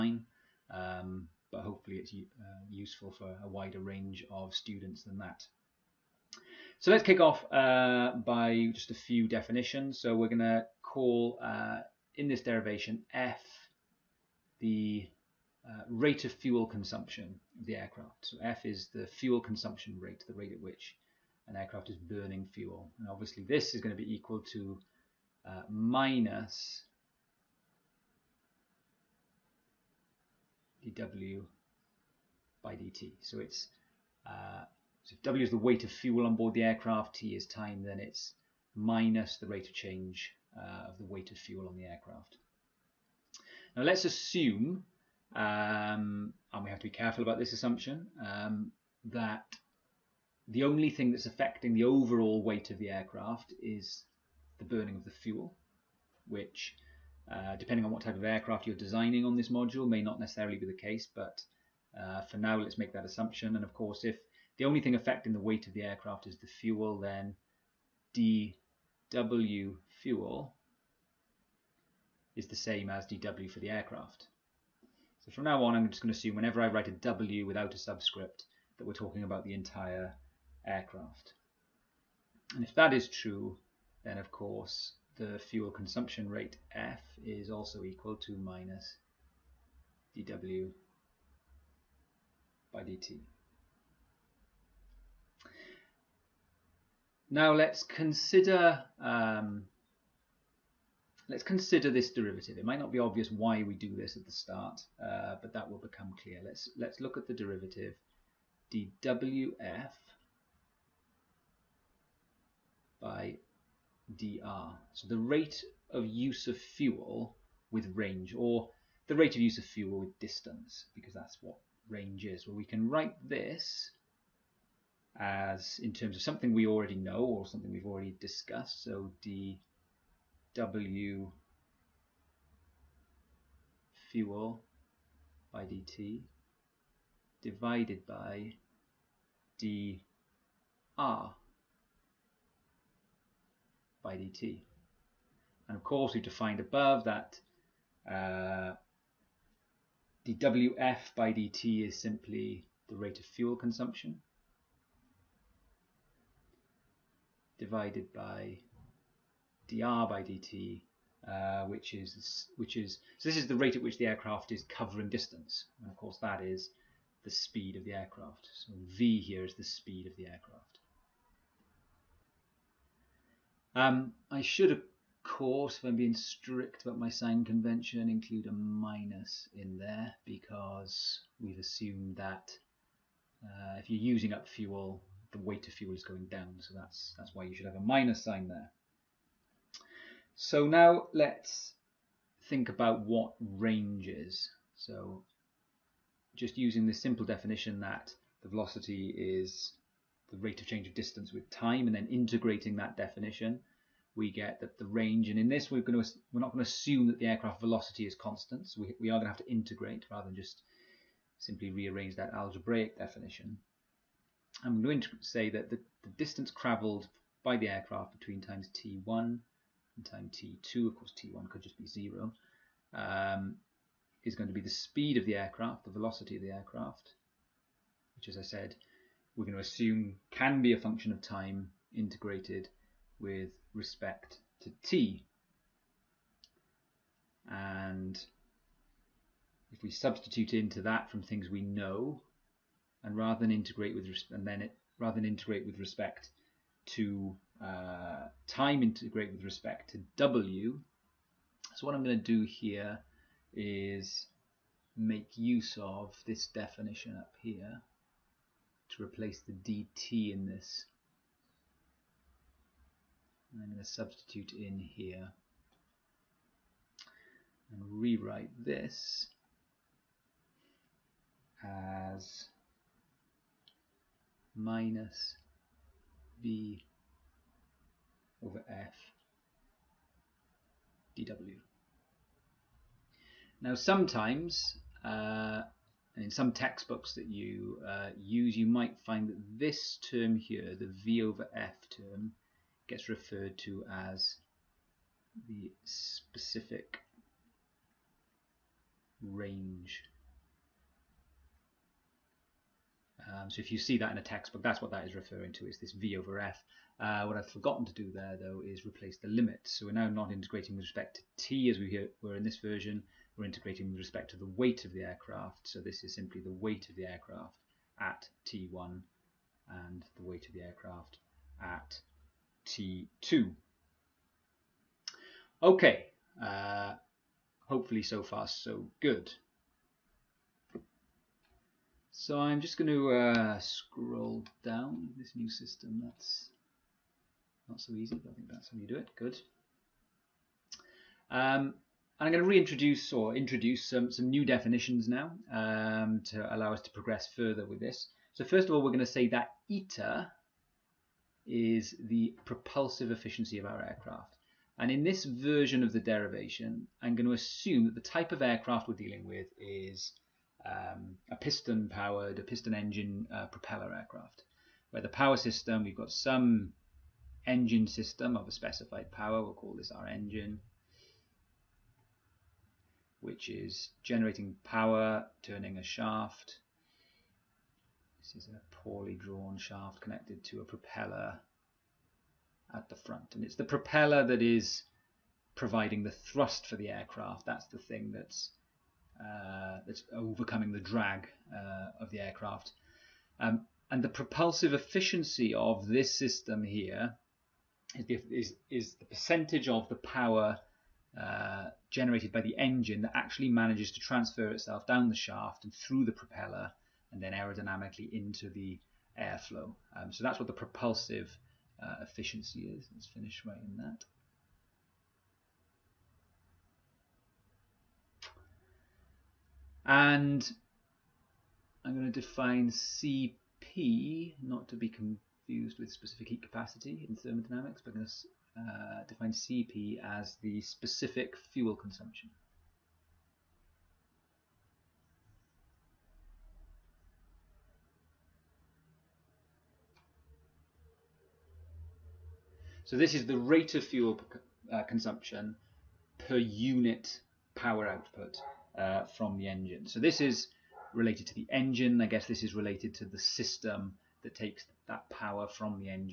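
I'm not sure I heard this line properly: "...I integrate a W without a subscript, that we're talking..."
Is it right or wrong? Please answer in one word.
wrong.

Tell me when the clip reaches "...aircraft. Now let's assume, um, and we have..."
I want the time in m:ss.
0:41.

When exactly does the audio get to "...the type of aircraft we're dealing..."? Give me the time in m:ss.
5:57.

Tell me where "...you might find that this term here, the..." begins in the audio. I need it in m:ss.
4:48.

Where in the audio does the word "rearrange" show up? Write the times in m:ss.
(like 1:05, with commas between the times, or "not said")
3:31.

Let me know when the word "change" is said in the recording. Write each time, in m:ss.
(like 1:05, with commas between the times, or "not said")
0:39, 3:20.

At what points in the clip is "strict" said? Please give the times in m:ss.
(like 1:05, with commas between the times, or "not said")
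2:56.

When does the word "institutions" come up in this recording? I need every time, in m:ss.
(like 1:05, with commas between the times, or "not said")
not said.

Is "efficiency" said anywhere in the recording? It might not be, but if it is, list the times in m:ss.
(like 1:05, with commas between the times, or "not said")
5:53, 6:34, 6:52.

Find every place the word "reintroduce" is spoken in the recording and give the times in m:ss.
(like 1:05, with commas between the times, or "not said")
5:42.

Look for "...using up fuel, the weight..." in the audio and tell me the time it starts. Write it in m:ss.
3:03.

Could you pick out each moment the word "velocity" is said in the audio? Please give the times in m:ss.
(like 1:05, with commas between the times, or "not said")
3:18, 3:27, 3:45.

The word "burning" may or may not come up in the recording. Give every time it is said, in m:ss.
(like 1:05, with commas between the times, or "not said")
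0:21, 0:54.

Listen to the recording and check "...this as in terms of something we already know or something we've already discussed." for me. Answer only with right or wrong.
right.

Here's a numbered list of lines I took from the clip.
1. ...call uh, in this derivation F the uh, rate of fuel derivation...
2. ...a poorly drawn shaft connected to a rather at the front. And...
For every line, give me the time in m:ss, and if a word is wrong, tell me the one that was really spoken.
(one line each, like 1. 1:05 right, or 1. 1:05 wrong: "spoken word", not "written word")
1. 0:10 wrong: "consumption", not "derivation"
2. 6:18 wrong: "propeller", not "rather".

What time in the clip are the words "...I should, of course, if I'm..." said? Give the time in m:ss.
2:54.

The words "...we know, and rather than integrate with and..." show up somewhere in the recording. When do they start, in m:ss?
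4:01.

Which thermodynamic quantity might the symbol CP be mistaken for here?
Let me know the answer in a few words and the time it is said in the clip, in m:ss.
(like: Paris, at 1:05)
specific heat capacity, at 7:05.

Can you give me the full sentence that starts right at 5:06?
Uh, what I've forgotten to do there, though, is replace the limit.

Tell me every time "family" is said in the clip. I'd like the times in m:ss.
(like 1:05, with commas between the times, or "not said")
not said.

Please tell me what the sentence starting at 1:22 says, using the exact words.
And if that is true, then of course the fuel consumption rate F is also equal to minus dW by dt.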